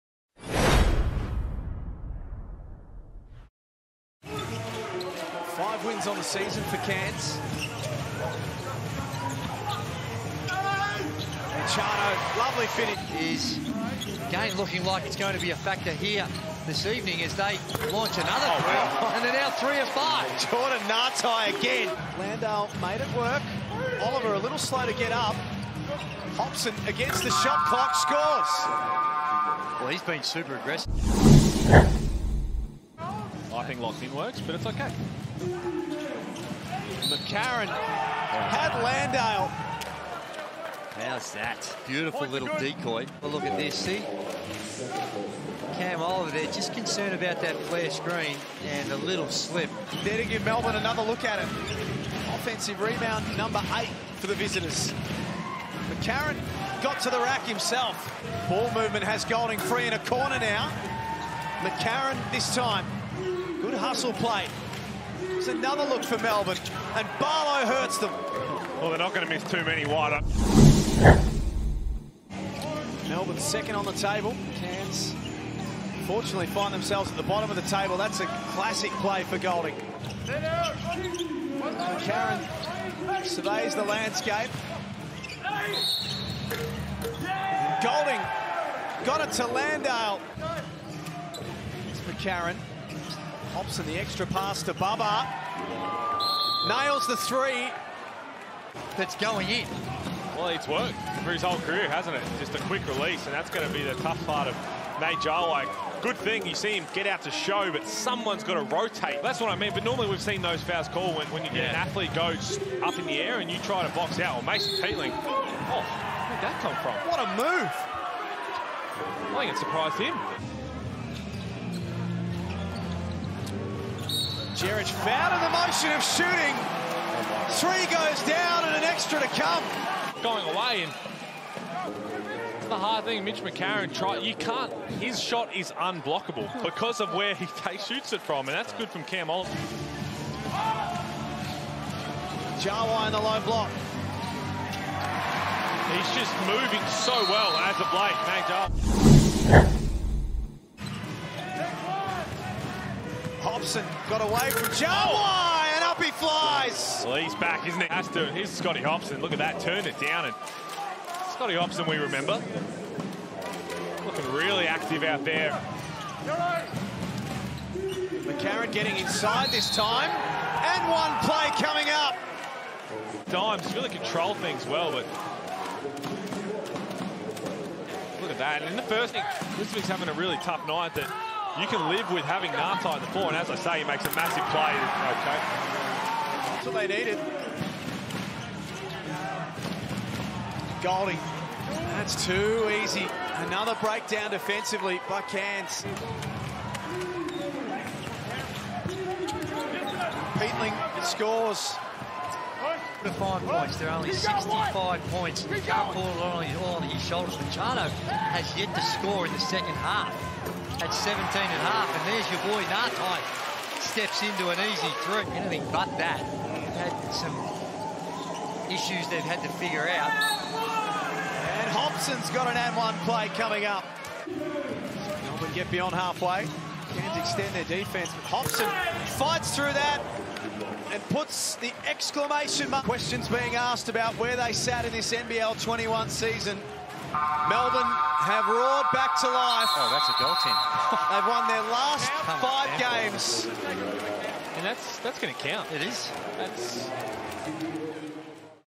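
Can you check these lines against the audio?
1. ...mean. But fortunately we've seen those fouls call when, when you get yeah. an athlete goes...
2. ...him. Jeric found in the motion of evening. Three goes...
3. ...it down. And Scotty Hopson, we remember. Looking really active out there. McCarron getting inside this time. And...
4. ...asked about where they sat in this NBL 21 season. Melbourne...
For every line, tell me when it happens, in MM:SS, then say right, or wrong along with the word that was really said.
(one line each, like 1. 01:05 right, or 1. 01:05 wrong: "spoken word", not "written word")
1. 01:49 wrong: "normally", not "fortunately"
2. 01:59 wrong: "shooting", not "evening"
3. 02:39 right
4. 03:53 right.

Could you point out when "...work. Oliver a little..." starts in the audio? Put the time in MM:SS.
00:23.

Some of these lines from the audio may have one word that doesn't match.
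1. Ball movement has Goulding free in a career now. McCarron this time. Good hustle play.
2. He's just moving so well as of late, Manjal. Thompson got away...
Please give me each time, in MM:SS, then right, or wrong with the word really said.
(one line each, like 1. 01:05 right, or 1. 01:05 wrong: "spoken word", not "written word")
1. 00:58 wrong: "corner", not "career"
2. 02:25 right.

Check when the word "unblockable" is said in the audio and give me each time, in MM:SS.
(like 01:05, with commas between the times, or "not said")
02:15.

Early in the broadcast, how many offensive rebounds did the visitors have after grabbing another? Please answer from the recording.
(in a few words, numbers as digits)
8.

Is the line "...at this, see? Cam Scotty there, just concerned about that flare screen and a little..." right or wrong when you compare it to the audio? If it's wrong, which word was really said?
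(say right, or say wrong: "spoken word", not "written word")
wrong: "Oliver", not "Scotty".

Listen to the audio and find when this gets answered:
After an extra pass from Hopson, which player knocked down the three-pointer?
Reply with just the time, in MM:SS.
01:34.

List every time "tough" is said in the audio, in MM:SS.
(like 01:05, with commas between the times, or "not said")
01:43, 03:00.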